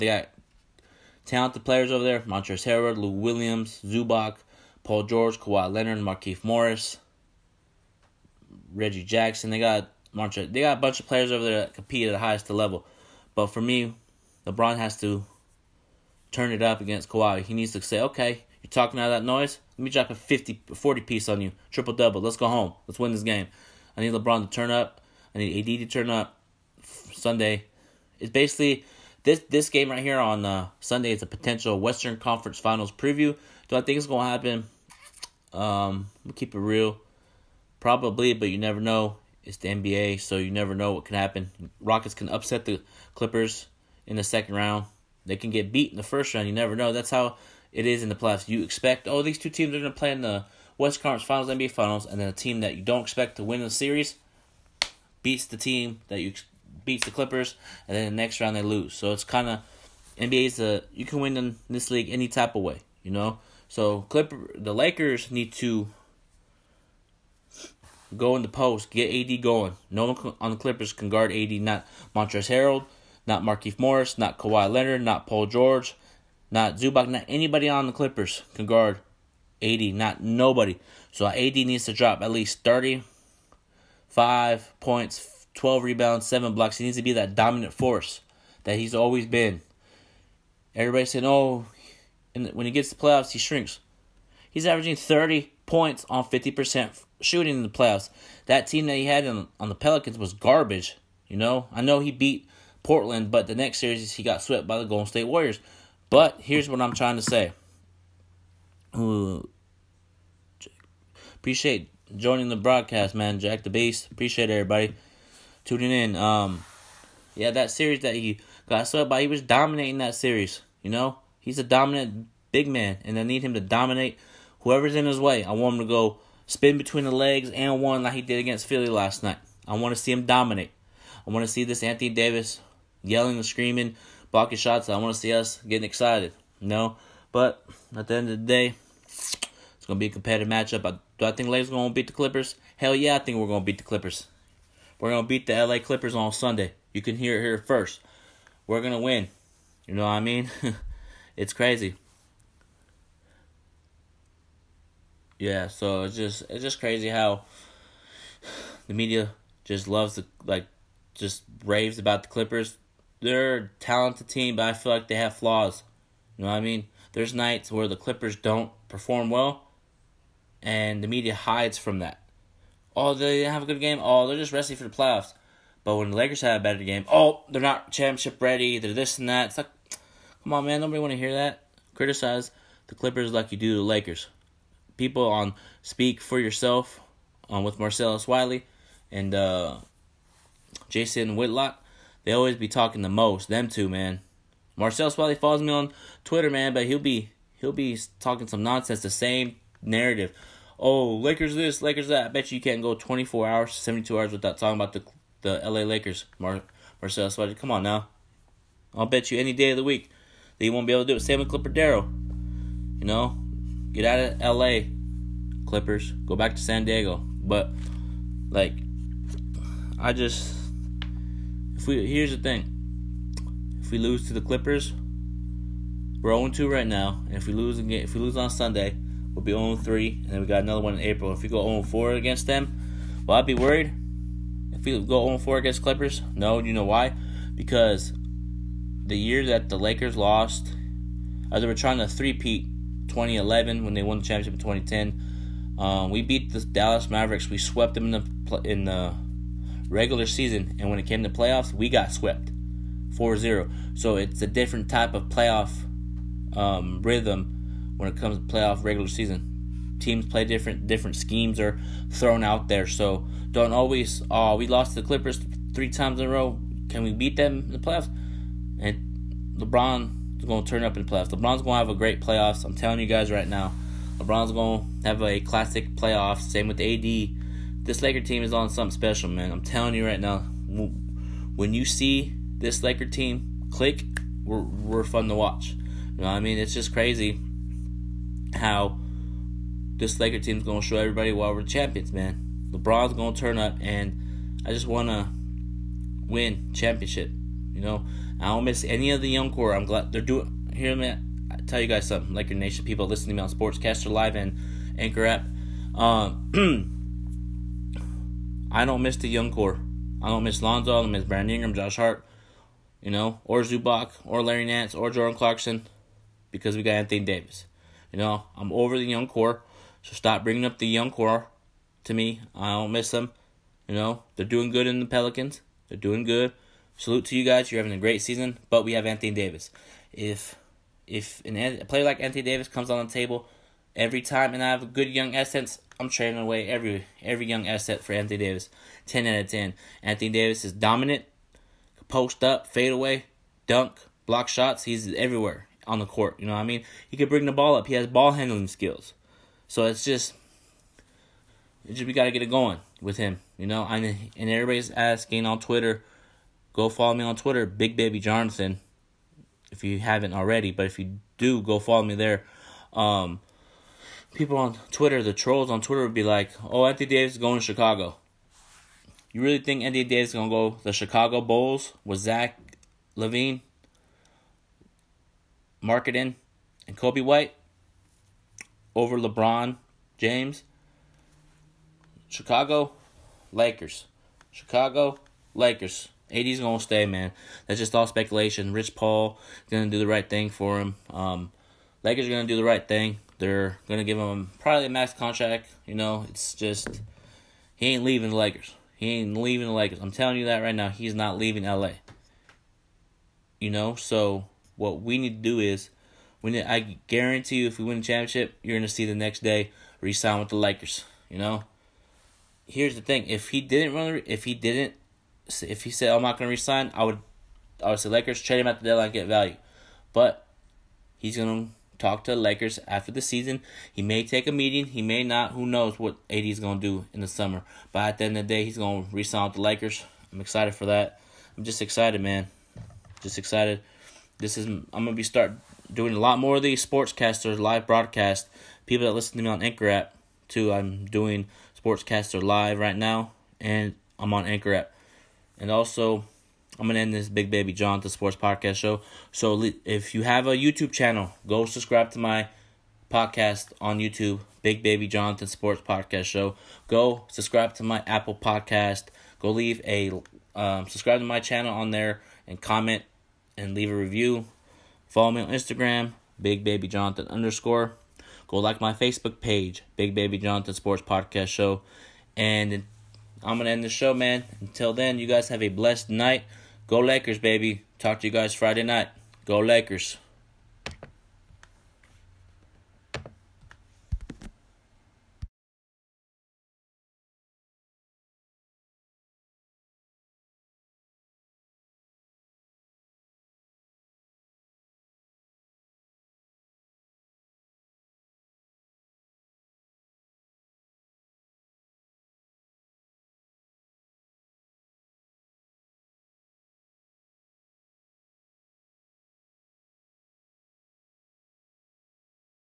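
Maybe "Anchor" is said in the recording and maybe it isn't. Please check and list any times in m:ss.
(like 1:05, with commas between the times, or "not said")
5:04, 7:19, 7:24.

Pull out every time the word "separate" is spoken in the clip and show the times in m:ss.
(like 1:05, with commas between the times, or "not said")
not said.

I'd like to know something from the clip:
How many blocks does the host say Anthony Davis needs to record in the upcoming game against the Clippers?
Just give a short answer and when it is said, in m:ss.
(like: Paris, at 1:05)
7, at 1:26.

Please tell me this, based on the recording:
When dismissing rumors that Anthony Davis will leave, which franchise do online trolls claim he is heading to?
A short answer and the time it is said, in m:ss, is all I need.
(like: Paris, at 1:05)
Chicago Bulls, at 6:10.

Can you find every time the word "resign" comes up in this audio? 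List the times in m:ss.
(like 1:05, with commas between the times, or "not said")
6:49, 6:56, 7:09.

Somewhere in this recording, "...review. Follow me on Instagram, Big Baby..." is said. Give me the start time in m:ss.
7:43.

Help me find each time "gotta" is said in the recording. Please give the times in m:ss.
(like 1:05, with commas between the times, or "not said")
5:52.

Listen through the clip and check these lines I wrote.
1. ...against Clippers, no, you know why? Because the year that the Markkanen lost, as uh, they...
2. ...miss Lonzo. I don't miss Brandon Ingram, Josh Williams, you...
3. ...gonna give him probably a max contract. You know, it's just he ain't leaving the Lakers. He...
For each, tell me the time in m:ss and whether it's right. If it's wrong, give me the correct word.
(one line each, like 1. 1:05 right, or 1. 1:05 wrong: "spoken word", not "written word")
1. 3:55 wrong: "Lakers", not "Markkanen"
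2. 5:10 wrong: "Hart", not "Williams"
3. 6:33 right.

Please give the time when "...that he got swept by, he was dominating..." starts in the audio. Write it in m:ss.
1:57.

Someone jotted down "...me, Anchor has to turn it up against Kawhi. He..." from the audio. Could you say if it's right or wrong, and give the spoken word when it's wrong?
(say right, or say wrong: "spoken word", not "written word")
wrong: "LeBron", not "Anchor".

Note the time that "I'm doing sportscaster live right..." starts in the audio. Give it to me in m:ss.
7:20.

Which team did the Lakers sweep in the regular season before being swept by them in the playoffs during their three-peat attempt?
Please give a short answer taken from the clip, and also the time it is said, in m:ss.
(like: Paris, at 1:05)
Dallas Mavericks, at 4:06.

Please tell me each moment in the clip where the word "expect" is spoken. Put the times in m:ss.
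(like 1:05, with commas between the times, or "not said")
0:48, 0:53.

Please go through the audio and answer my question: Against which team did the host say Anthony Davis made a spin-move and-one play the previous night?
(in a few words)
Philly.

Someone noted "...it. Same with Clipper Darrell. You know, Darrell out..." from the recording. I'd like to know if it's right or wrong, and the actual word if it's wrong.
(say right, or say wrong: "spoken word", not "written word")
wrong: "Get", not "Darrell".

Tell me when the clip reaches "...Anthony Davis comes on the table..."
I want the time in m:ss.
5:32.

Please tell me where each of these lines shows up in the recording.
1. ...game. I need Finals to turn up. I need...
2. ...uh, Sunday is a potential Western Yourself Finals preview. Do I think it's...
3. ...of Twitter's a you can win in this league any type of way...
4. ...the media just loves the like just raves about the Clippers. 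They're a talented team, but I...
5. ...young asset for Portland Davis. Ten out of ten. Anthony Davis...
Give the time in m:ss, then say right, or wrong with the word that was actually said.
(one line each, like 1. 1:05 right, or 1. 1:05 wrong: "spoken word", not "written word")
1. 0:23 wrong: "LeBron", not "Finals"
2. 0:30 wrong: "Conference", not "Yourself"
3. 0:59 wrong: "NBA", not "Twitter"
4. 2:38 right
5. 5:37 wrong: "Anthony", not "Portland".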